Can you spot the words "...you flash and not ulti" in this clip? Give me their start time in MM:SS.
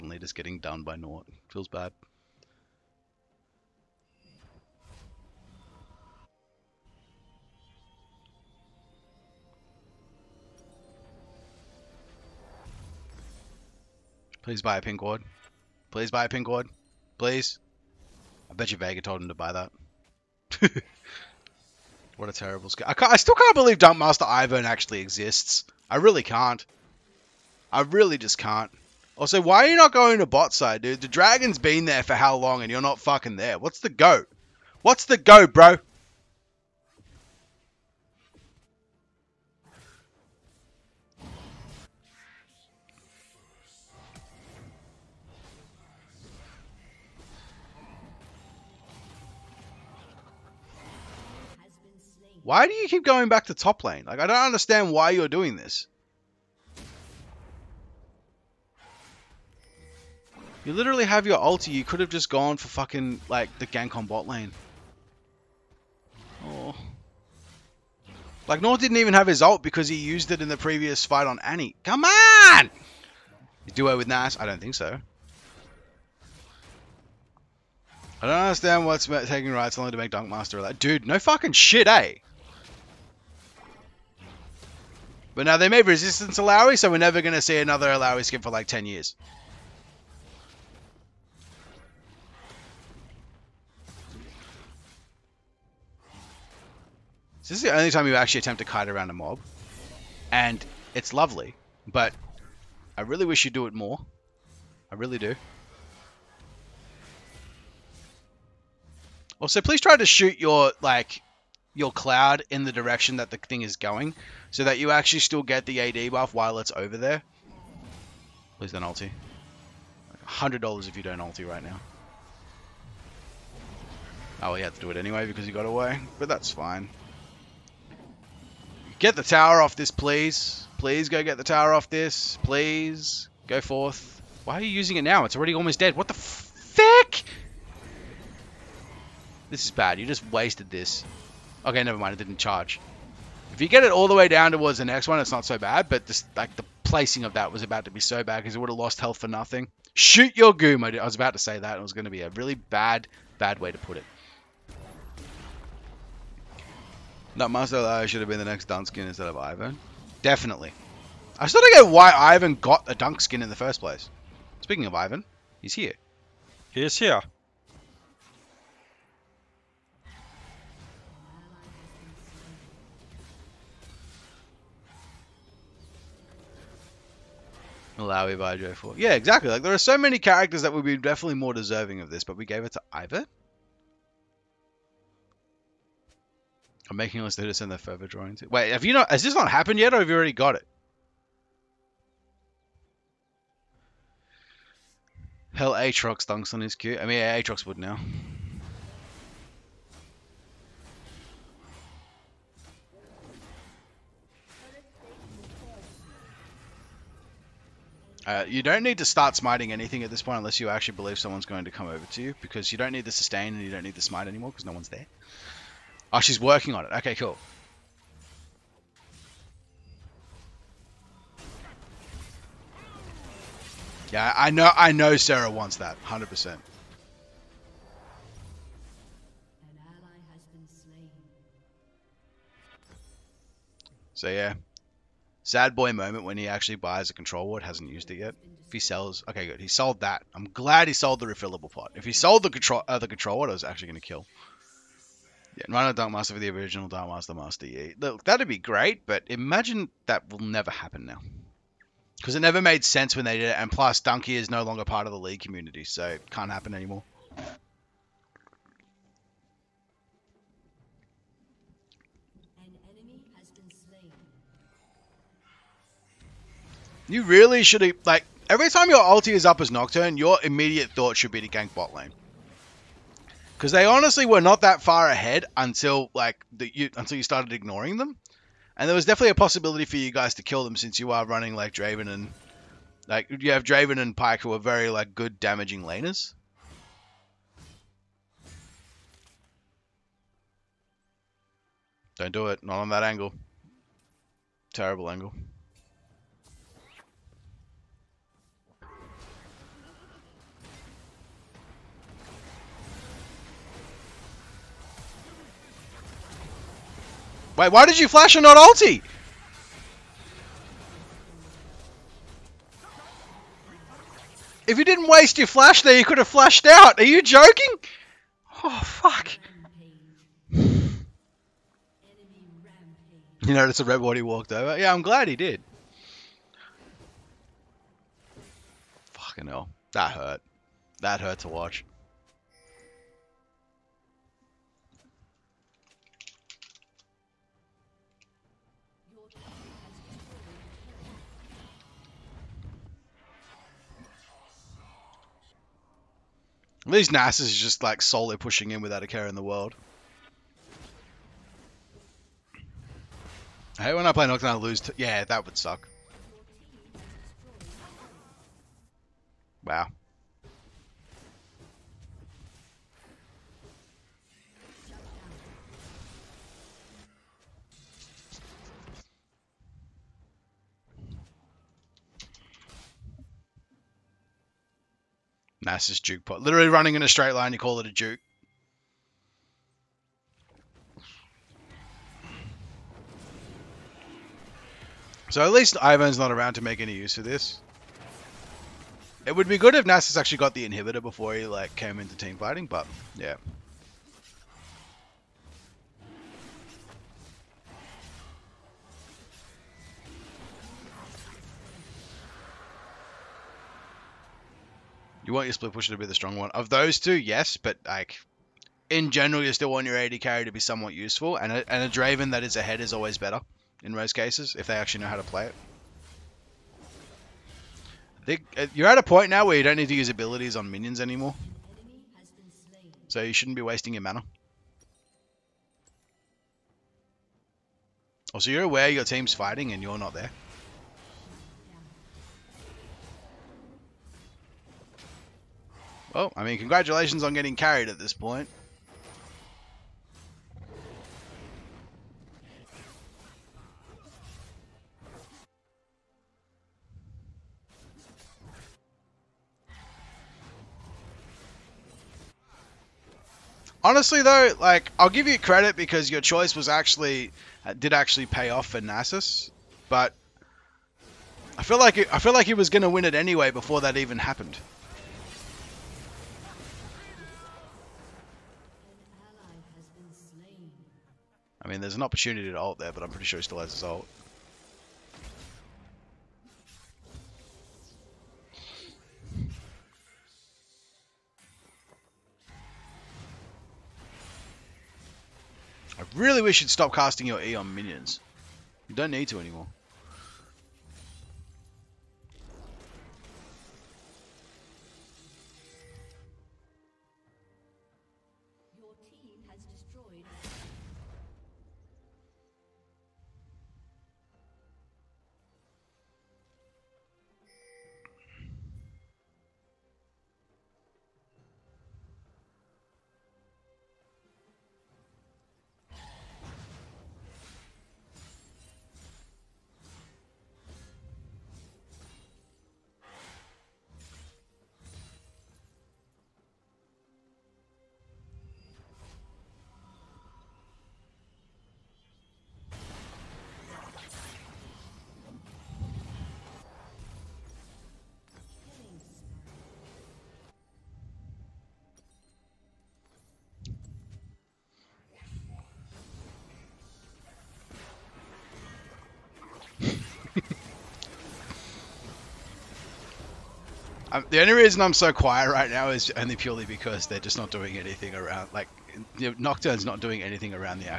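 05:07.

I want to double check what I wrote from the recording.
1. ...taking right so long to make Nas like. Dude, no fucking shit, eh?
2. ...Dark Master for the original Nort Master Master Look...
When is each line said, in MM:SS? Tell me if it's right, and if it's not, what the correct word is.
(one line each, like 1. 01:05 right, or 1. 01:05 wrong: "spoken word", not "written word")
1. 01:19 wrong: "Dunkmaster", not "Nas"
2. 04:05 wrong: "Dark", not "Nort".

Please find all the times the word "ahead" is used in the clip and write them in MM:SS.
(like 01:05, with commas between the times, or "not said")
04:35, 06:52.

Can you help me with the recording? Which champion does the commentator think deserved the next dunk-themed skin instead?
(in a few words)
Marcel.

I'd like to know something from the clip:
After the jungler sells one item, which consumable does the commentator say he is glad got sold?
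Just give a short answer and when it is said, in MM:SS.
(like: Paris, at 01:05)
refillable pot, at 04:01.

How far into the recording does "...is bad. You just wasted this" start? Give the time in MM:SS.
02:19.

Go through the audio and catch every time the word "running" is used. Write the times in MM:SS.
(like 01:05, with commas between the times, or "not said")
04:41, 06:16.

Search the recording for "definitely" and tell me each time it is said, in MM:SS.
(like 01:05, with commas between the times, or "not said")
02:40, 03:00, 04:39.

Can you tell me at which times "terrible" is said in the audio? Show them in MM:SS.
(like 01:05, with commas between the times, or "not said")
00:22, 04:54.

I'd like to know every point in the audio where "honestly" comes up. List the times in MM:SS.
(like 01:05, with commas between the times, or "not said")
04:33, 07:33.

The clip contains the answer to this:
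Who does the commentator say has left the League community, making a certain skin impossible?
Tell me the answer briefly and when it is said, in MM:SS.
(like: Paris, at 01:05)
Donkey, at 04:13.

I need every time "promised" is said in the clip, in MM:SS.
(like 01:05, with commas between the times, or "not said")
not said.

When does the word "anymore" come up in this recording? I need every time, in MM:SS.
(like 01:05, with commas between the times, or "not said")
03:34, 04:16, 07:00, 08:09.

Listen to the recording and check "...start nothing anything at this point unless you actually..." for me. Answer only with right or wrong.
wrong.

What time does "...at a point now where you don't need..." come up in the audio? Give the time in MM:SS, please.
06:58.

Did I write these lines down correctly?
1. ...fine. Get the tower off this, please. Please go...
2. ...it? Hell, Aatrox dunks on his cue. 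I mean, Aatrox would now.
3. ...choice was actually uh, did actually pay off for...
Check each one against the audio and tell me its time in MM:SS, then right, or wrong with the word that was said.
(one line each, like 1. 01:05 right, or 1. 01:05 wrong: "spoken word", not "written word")
1. 02:06 right
2. 03:10 right
3. 07:36 right.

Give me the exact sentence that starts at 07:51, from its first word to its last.
I mean, there's an opportunity to alt there, but I'm pretty sure he still has his alt.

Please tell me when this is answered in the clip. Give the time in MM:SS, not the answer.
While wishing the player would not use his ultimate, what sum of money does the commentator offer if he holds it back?
02:00.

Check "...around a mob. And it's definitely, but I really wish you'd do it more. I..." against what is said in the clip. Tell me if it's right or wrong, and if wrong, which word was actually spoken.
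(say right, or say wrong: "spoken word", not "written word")
wrong: "lovely", not "definitely".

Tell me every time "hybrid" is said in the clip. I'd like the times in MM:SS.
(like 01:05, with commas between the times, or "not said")
not said.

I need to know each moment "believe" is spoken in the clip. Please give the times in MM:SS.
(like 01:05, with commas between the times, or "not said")
00:23, 03:30.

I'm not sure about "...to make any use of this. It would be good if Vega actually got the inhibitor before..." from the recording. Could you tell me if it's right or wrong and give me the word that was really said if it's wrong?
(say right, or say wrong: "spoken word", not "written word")
wrong: "Nasus", not "Vega".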